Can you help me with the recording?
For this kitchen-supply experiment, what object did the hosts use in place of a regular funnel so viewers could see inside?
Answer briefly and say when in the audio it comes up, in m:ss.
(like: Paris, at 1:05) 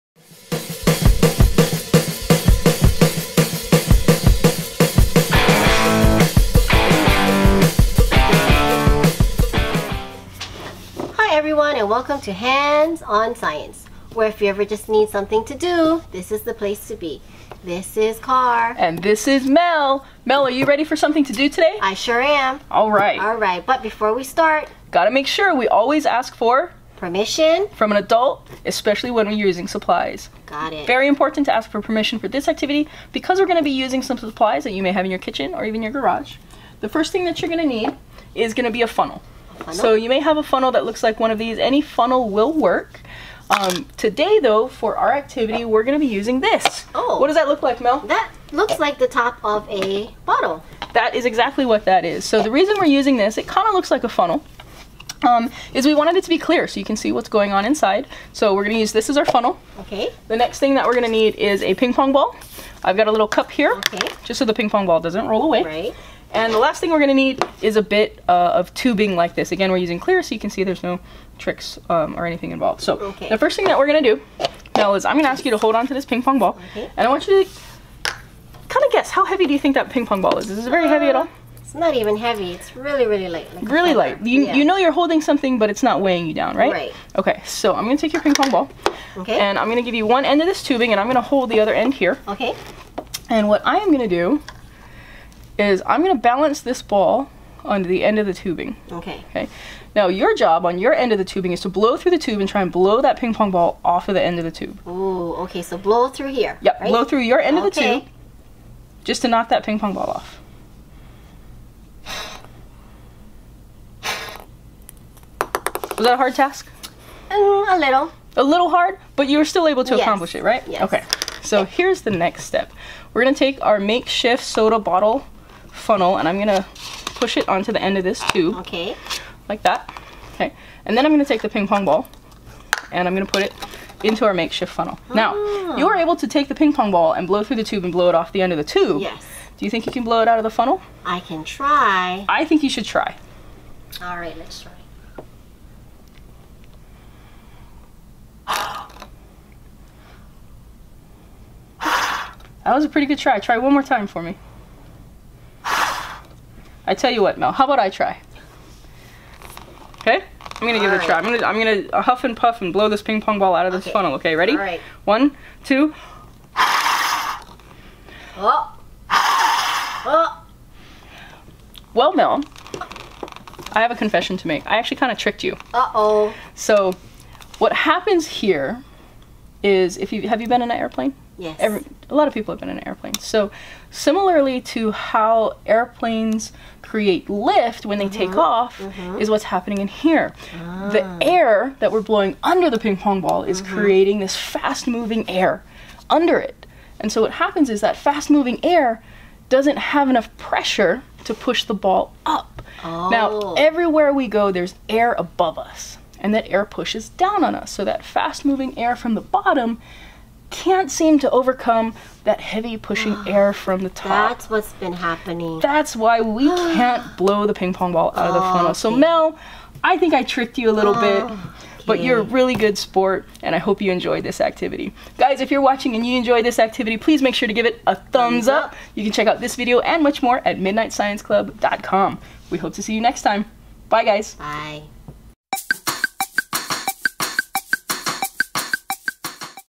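top of a bottle, at 0:48.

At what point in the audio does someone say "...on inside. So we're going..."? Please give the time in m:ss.
0:57.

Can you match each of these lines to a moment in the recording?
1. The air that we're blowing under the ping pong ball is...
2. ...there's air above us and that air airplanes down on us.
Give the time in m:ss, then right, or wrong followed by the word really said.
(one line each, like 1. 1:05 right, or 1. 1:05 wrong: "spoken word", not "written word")
1. 3:10 right
2. 3:24 wrong: "pushes", not "airplanes".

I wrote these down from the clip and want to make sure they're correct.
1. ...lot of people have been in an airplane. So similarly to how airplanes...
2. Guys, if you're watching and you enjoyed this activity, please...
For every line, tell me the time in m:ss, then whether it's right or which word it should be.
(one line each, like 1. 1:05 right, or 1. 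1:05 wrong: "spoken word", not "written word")
1. 3:02 right
2. 3:45 right.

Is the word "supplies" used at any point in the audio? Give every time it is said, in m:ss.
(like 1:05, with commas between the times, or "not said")
0:29, 0:34.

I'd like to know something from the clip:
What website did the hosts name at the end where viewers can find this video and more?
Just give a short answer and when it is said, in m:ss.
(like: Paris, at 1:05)
midnightscienceclub.com, at 3:50.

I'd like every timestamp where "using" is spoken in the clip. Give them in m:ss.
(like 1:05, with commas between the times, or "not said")
0:29, 0:33, 0:46, 0:52, 1:09.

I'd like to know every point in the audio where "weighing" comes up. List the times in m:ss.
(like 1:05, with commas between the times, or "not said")
1:26.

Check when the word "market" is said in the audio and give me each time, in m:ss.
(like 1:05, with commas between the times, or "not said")
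not said.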